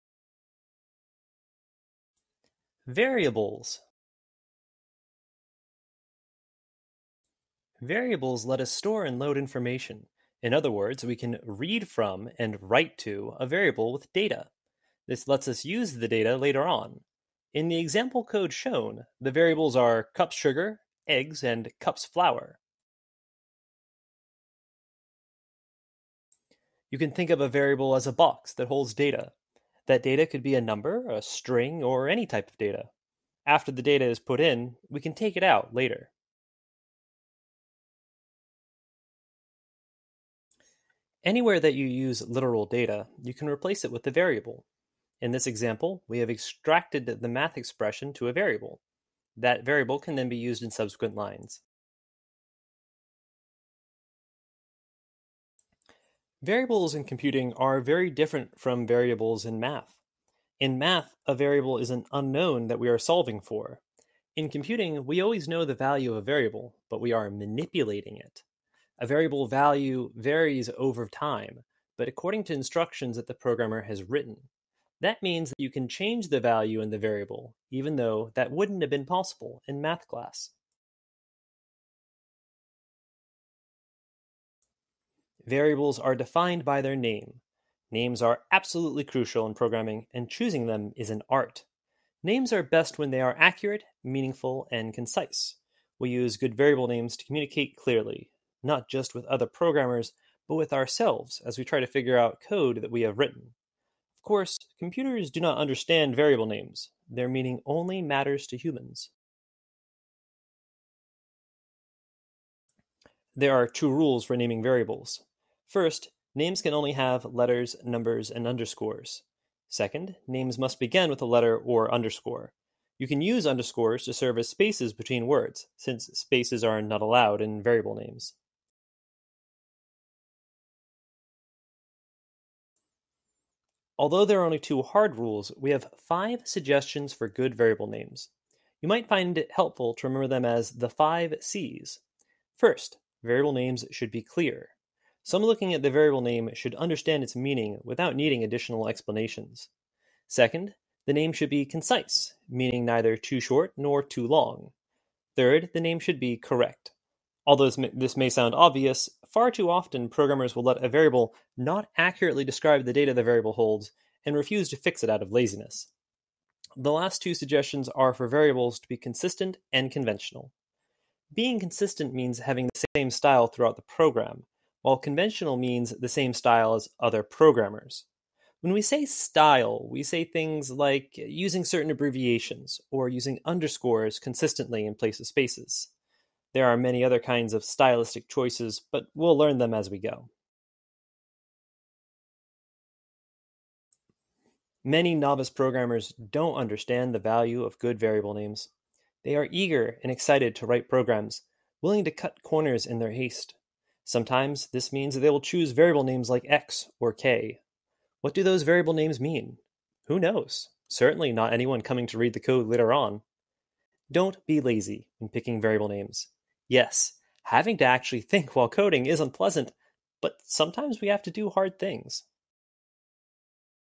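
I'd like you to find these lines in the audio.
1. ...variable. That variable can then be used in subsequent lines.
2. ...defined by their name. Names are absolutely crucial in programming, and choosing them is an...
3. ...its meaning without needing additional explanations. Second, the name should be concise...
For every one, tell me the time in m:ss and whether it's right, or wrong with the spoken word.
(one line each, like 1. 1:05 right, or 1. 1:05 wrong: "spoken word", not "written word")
1. 0:48 right
2. 1:26 right
3. 2:27 right.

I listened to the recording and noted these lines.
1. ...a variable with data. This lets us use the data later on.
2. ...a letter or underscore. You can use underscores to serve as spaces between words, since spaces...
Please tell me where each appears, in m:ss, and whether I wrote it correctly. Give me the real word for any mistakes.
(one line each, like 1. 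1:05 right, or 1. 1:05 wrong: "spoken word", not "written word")
1. 0:13 right
2. 2:01 right.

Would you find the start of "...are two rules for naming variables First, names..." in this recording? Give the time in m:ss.
1:53.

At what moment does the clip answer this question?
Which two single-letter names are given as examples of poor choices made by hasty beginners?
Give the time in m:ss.
3:26.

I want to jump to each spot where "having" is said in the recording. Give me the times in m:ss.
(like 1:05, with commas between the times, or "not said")
2:52, 3:37.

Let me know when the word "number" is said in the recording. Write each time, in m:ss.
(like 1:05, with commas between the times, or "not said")
0:30, 1:57.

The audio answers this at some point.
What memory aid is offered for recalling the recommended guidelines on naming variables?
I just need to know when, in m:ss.
2:20.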